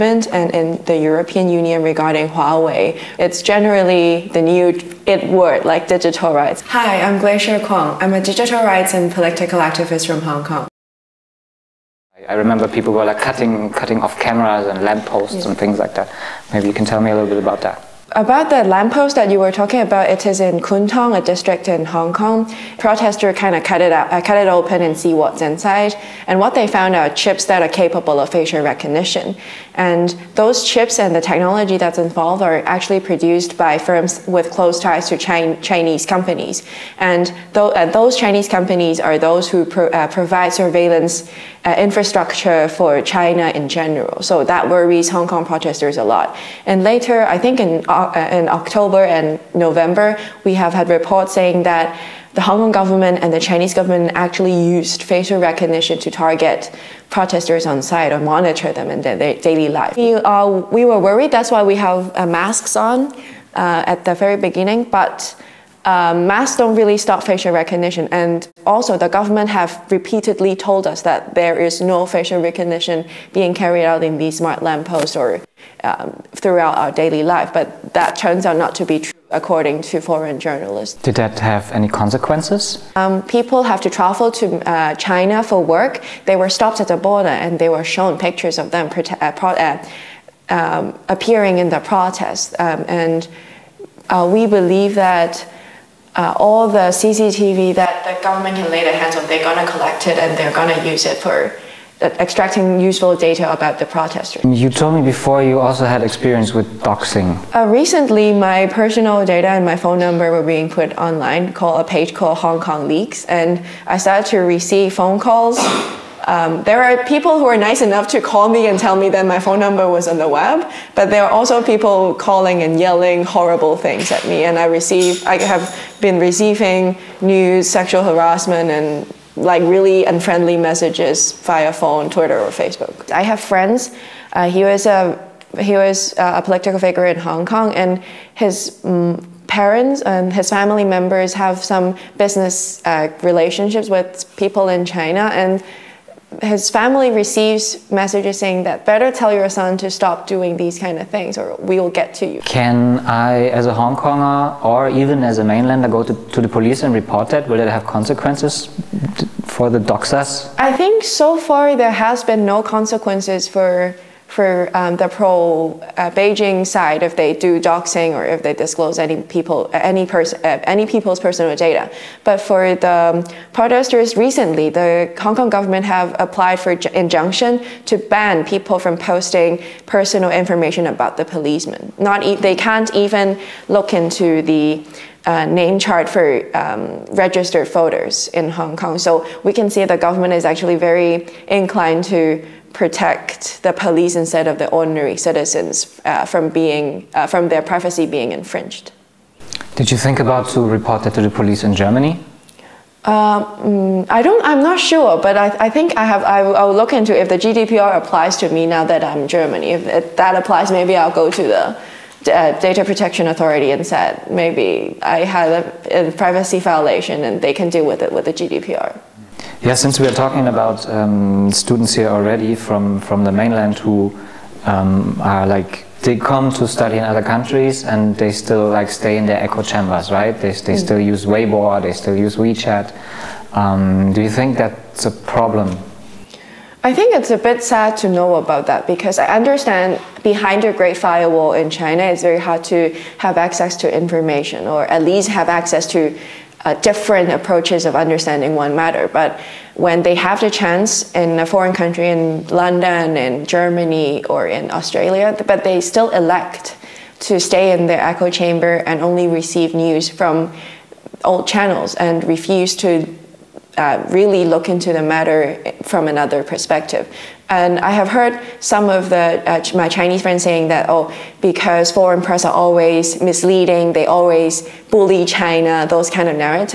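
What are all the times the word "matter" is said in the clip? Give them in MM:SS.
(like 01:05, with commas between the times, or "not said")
04:08, 04:25.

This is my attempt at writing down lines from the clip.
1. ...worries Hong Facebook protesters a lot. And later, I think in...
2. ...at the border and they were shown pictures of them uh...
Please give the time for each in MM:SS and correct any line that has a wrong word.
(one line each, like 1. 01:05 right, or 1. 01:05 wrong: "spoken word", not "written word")
1. 00:44 wrong: "Kong", not "Facebook"
2. 01:26 right.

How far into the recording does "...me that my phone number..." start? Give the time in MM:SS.
01:58.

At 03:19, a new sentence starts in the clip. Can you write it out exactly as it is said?
Did you think about to report that to the police in Germany?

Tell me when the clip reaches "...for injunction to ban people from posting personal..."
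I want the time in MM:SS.
02:56.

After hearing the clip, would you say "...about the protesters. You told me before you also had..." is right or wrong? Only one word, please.
right.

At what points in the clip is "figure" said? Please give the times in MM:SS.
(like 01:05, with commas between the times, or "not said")
02:16.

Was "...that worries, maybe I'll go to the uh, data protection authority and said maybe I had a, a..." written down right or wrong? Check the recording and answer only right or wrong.
wrong.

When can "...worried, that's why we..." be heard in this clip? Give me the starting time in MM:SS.
01:00.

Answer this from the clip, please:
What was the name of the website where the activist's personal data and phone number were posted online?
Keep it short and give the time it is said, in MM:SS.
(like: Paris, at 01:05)
Hong Kong Leaks, at 01:52.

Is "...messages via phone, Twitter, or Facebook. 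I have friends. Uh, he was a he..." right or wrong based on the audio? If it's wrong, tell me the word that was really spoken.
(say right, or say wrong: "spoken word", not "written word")
right.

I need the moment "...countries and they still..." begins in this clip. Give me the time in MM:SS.
03:47.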